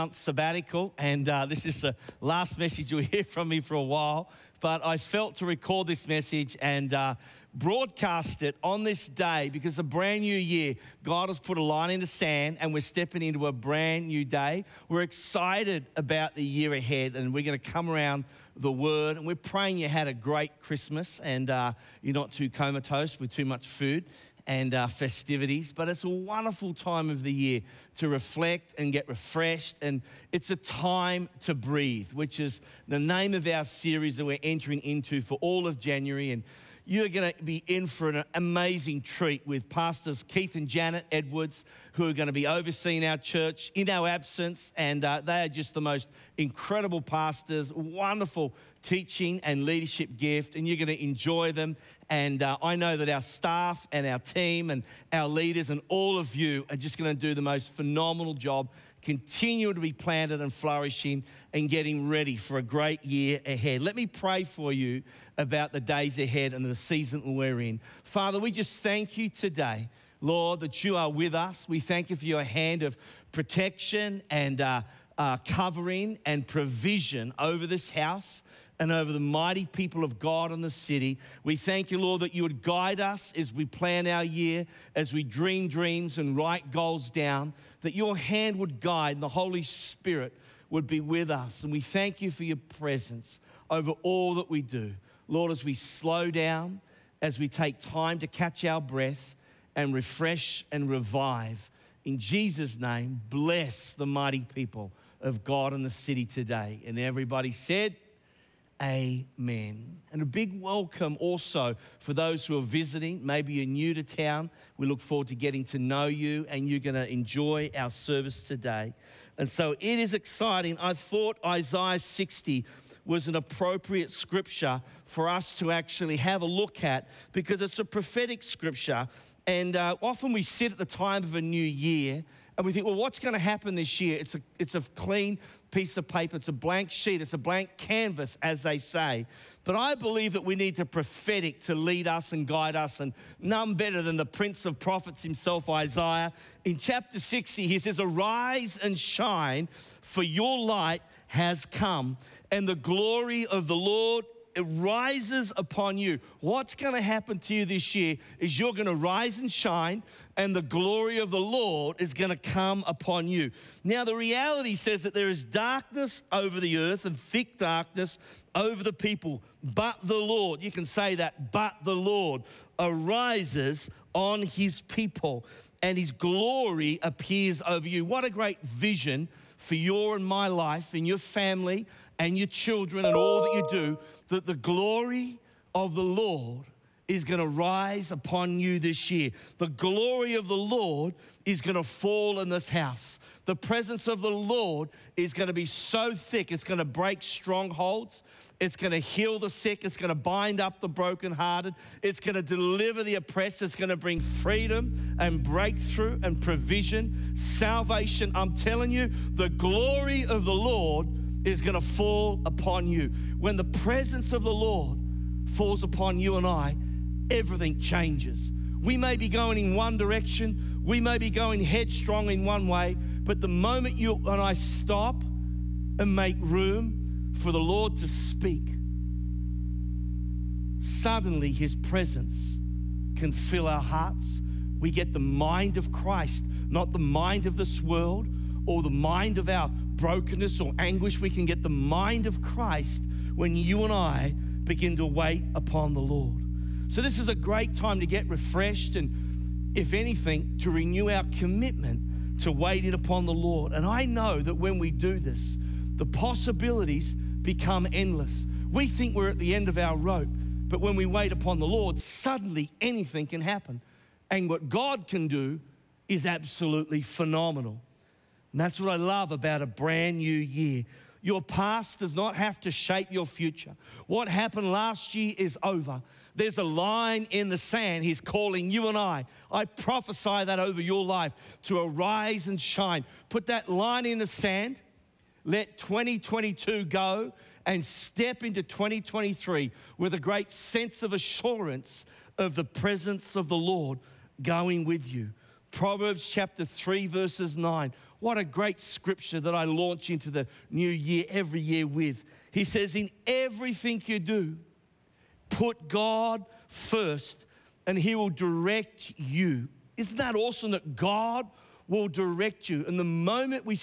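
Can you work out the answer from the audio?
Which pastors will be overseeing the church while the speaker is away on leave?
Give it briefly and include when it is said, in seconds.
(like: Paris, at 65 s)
Keith and Janet Edwards, at 40 s.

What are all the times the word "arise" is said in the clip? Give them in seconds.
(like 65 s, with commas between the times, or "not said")
147 s, 172 s, 281 s.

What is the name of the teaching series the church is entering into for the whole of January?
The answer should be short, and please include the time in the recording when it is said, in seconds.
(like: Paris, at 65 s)
Breathe, at 31 s.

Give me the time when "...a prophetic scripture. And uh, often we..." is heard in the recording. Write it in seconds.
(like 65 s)
127 s.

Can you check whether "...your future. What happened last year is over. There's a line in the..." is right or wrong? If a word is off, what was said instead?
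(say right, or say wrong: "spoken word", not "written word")
right.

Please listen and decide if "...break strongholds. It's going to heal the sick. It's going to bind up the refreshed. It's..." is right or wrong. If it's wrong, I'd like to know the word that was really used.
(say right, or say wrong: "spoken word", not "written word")
wrong: "brokenhearted", not "refreshed".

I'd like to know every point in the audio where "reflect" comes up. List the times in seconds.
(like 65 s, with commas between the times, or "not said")
28 s.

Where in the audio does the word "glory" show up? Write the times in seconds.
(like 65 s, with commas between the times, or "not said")
152 s, 160 s, 176 s, 184 s, 189 s, 209 s.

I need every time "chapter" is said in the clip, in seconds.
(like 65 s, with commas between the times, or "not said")
146 s, 296 s.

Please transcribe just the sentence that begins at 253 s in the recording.
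And I know that when we do this, the possibilities become endless.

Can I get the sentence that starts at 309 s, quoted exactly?
Isn't that awesome that God will direct you?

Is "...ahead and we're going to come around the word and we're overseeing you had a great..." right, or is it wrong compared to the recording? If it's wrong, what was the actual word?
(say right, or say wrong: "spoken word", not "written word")
wrong: "praying", not "overseeing".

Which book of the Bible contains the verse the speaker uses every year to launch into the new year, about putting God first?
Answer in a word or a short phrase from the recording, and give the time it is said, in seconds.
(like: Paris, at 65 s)
Proverbs, at 295 s.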